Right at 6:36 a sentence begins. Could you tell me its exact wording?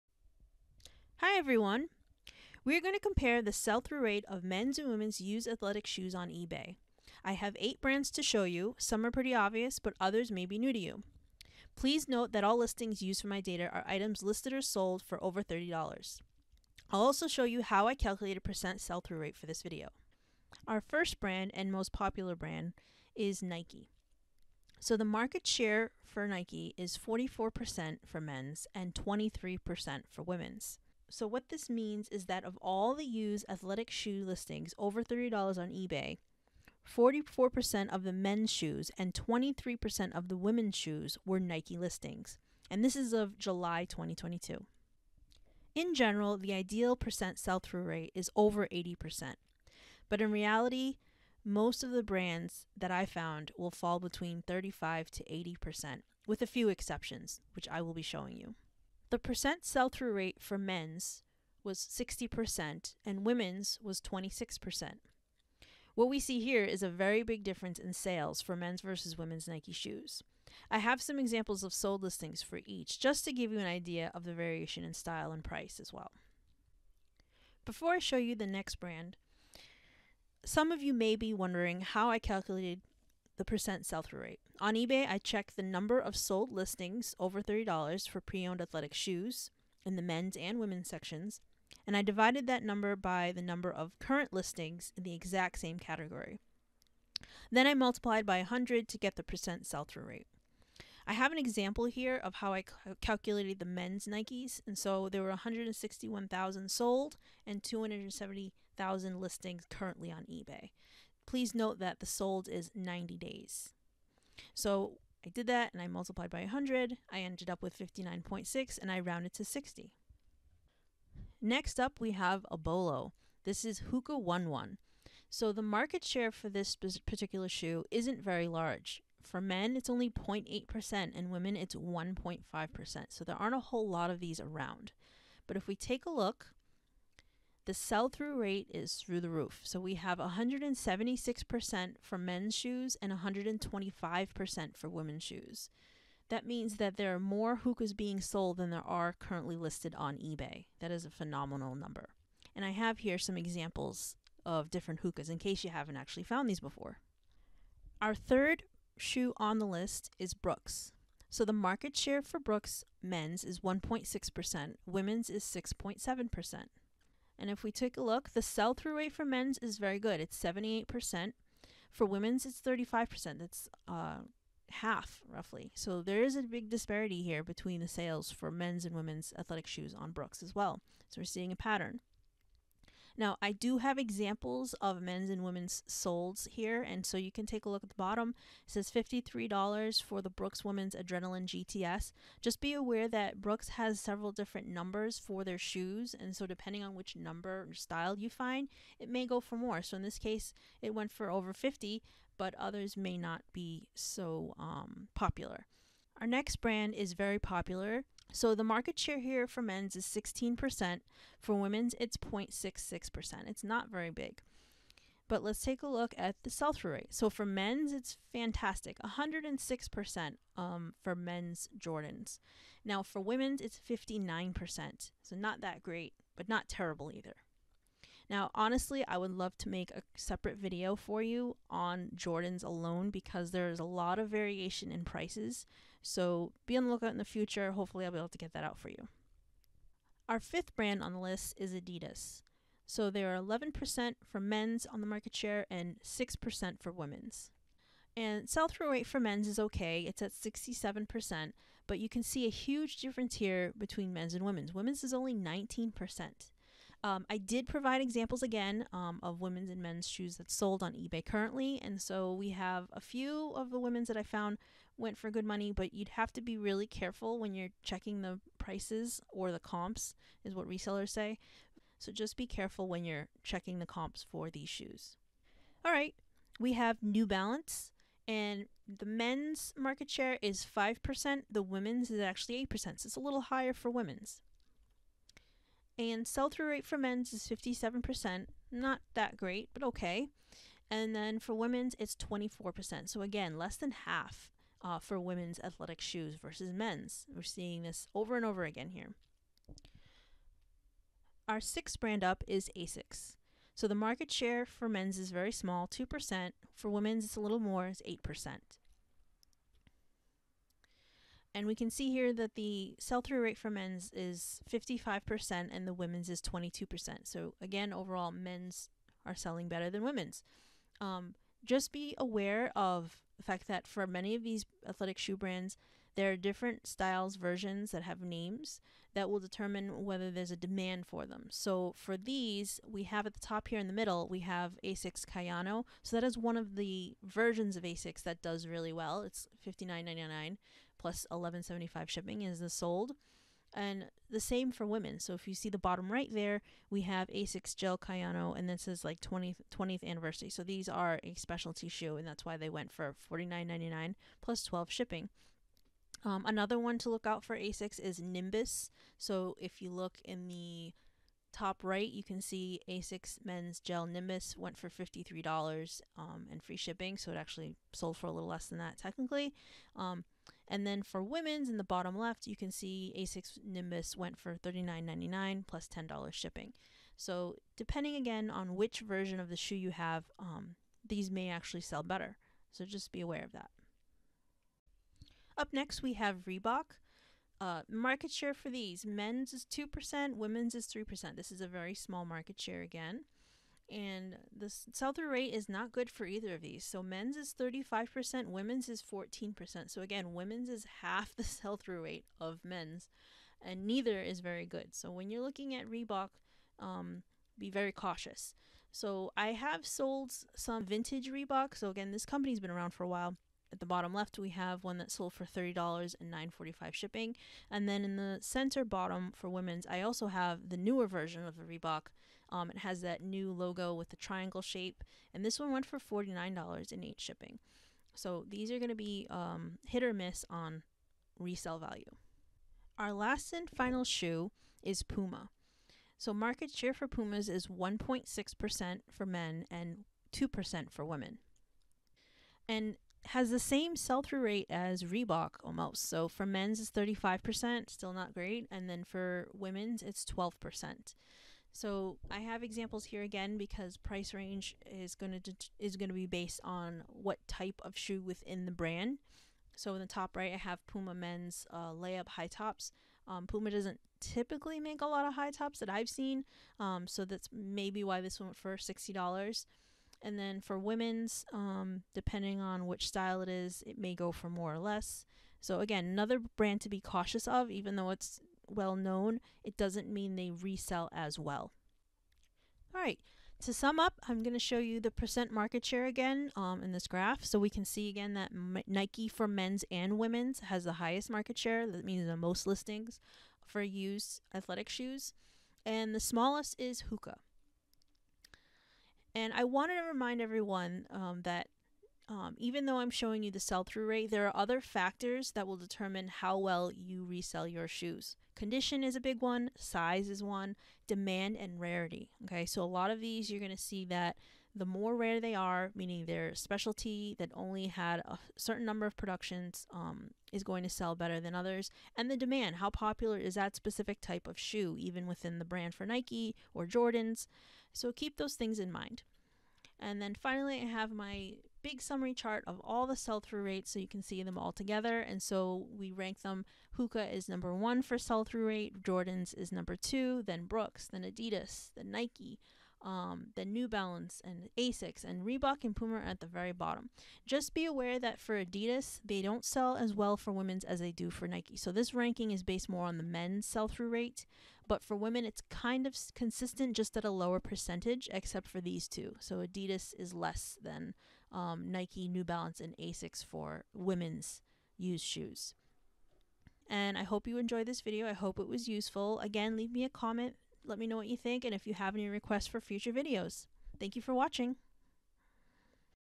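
So men's is 35%, women's is 14%.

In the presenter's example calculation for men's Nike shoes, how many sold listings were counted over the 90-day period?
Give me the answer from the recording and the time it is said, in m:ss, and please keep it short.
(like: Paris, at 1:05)
161,000, at 1:45.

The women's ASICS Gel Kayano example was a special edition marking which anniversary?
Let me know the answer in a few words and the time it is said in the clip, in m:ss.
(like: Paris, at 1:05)
20th, at 5:49.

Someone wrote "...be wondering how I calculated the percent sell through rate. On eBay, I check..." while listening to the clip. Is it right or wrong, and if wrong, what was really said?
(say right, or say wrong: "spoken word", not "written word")
right.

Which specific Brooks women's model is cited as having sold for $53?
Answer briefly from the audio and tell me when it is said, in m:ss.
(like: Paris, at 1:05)
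Adrenaline GTS, at 3:10.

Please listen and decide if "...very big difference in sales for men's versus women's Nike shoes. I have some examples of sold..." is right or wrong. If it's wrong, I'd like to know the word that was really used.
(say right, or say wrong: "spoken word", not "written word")
right.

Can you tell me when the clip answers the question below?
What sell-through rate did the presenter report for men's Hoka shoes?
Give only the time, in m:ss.
2:20.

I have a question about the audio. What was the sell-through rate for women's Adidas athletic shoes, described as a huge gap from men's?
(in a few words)
19%.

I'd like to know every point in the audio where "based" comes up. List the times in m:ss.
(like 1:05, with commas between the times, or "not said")
7:36, 9:12.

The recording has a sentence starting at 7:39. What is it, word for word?
So in the top right, I have Puma men's uh, layup high tops.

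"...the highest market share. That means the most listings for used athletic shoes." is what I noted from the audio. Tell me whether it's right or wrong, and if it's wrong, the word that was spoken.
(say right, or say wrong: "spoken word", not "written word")
right.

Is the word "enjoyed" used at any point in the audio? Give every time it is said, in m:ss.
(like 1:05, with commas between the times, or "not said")
9:27.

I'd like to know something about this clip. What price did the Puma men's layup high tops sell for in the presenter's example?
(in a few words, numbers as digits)
$60.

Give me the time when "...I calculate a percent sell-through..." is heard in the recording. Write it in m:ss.
0:17.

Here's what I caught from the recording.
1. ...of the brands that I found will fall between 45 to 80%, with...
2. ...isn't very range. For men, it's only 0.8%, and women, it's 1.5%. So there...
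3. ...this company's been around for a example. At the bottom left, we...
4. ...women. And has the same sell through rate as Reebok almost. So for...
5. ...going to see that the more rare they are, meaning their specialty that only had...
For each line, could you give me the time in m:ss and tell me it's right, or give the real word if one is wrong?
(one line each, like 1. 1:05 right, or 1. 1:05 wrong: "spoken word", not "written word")
1. 0:51 wrong: "35", not "45"
2. 2:07 wrong: "large", not "range"
3. 6:52 wrong: "while", not "example"
4. 7:21 right
5. 8:33 right.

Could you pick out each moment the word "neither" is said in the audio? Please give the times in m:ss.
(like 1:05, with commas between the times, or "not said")
6:43.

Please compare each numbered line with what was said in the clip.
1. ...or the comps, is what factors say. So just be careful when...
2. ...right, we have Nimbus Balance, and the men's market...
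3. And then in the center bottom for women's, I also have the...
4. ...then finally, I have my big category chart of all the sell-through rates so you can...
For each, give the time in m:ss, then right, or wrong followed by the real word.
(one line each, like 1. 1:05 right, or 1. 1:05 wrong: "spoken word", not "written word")
1. 4:29 wrong: "resellers", not "factors"
2. 4:35 wrong: "New", not "Nimbus"
3. 6:57 right
4. 8:50 wrong: "summary", not "category".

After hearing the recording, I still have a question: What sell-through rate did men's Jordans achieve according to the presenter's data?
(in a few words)
106%.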